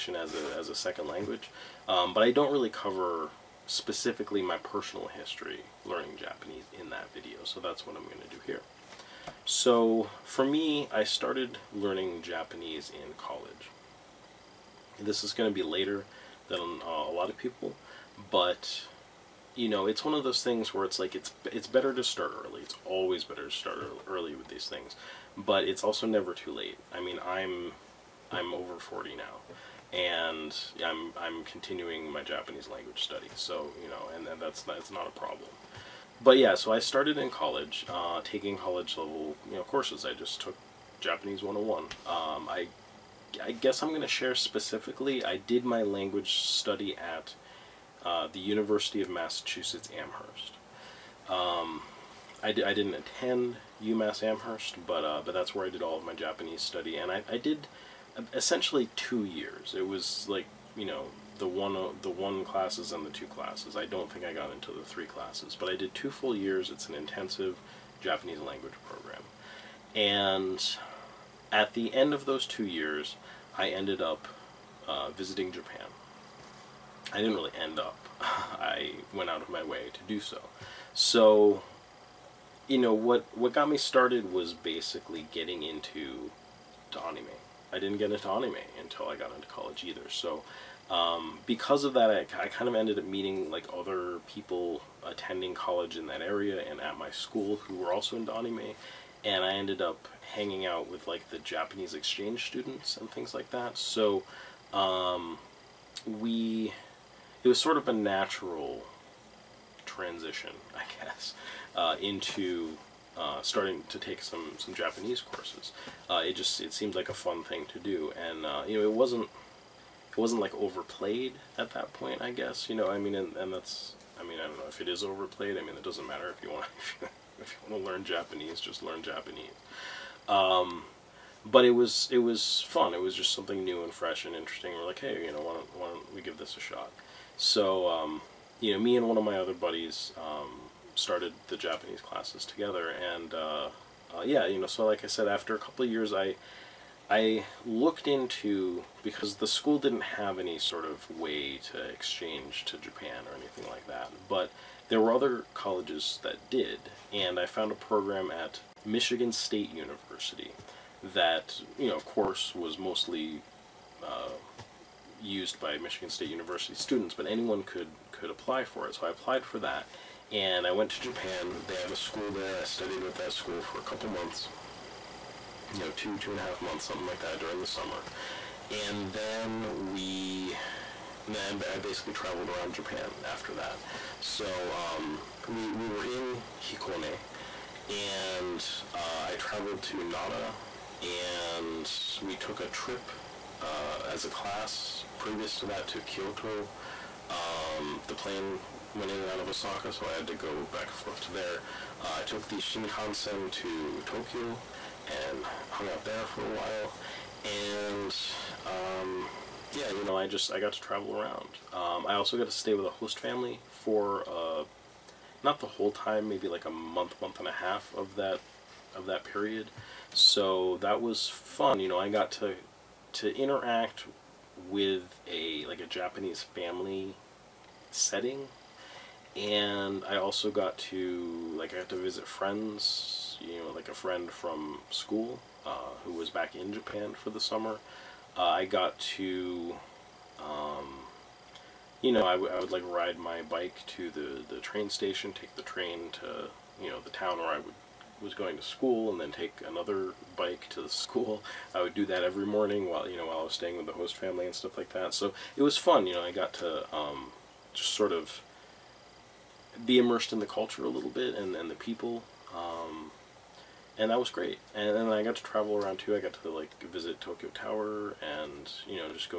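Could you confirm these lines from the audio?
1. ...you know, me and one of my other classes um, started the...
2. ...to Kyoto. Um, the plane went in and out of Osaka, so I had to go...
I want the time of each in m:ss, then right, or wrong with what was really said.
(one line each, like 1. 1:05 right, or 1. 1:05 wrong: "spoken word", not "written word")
1. 2:18 wrong: "buddies", not "classes"
2. 3:15 right.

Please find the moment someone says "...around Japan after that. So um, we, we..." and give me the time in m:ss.
3:02.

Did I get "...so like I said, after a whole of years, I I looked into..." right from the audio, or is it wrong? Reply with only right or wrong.
wrong.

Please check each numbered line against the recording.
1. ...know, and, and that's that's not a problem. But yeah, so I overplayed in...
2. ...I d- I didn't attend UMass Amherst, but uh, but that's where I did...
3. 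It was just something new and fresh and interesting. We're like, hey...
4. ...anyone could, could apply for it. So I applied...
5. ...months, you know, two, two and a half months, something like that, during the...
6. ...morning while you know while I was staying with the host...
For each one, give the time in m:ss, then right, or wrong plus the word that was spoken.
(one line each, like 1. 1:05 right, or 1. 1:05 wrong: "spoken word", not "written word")
1. 0:33 wrong: "started", not "overplayed"
2. 0:52 right
3. 2:12 right
4. 2:47 right
5. 2:54 right
6. 4:12 right.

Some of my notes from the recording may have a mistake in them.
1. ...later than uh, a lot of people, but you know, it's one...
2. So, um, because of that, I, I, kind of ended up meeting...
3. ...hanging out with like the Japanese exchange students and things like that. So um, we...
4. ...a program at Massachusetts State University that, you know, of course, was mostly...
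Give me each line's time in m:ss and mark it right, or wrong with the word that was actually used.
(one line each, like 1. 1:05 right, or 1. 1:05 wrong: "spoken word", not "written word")
1. 0:15 right
2. 1:30 right
3. 1:40 right
4. 2:37 wrong: "Michigan", not "Massachusetts".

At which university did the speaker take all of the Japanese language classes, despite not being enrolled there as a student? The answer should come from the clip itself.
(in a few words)
University of Massachusetts Amherst.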